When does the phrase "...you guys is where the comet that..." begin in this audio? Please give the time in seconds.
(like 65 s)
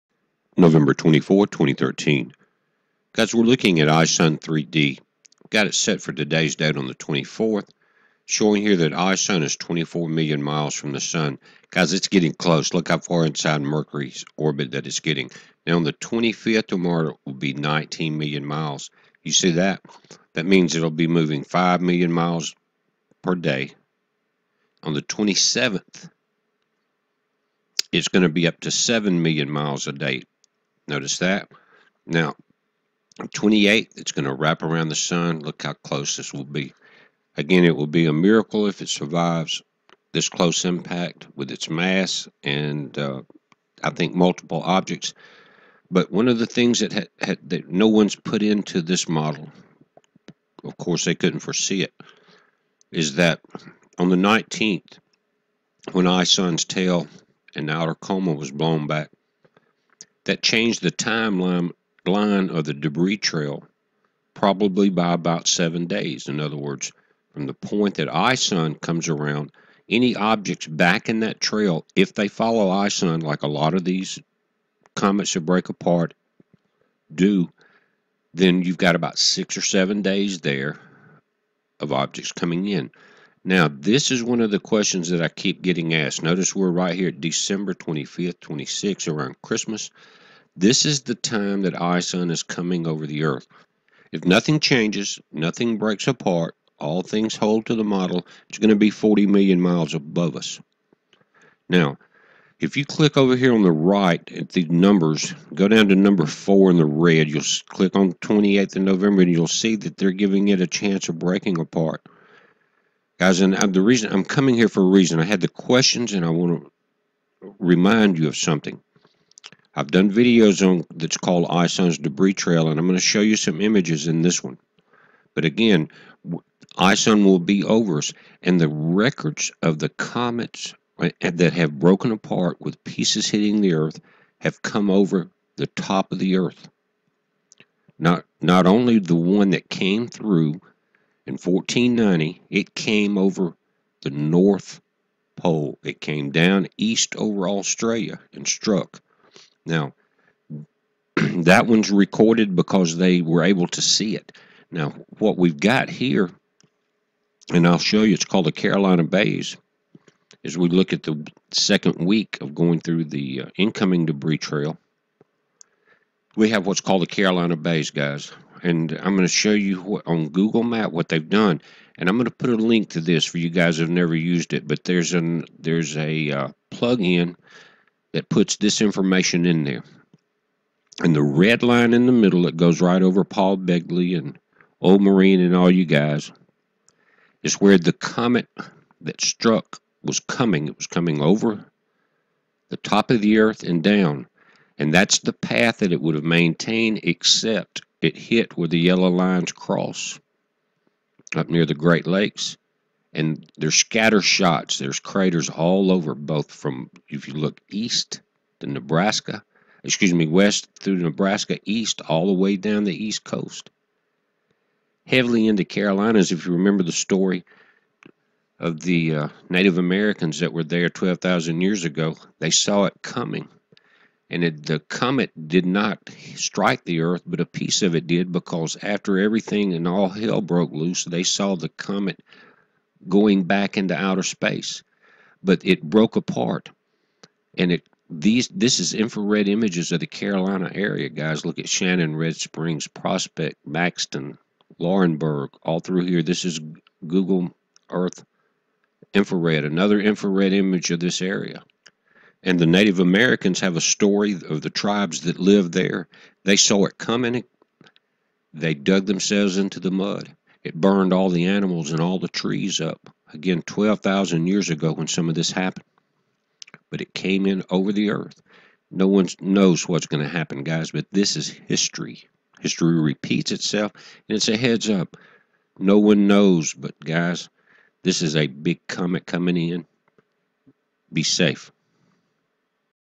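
185 s.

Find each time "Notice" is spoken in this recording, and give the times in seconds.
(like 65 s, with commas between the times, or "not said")
30 s, 86 s.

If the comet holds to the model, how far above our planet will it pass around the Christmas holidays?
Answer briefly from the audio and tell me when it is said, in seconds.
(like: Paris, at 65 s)
40 million miles, at 98 s.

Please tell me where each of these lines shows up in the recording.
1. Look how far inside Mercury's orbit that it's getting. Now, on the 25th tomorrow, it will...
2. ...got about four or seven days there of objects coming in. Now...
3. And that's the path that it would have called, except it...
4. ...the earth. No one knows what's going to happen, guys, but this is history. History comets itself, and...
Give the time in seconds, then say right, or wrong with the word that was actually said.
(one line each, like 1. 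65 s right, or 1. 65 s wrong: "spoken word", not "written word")
1. 12 s right
2. 78 s wrong: "six", not "four"
3. 194 s wrong: "maintained", not "called"
4. 267 s wrong: "repeats", not "comets".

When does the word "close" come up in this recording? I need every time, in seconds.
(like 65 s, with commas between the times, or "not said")
12 s, 35 s, 40 s.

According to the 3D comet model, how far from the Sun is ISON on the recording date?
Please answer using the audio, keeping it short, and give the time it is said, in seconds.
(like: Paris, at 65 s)
24 million miles, at 9 s.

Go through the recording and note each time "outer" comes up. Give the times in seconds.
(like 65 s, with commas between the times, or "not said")
57 s, 233 s.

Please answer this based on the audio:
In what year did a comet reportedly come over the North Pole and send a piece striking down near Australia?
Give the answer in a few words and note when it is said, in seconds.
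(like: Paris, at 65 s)
1490, at 141 s.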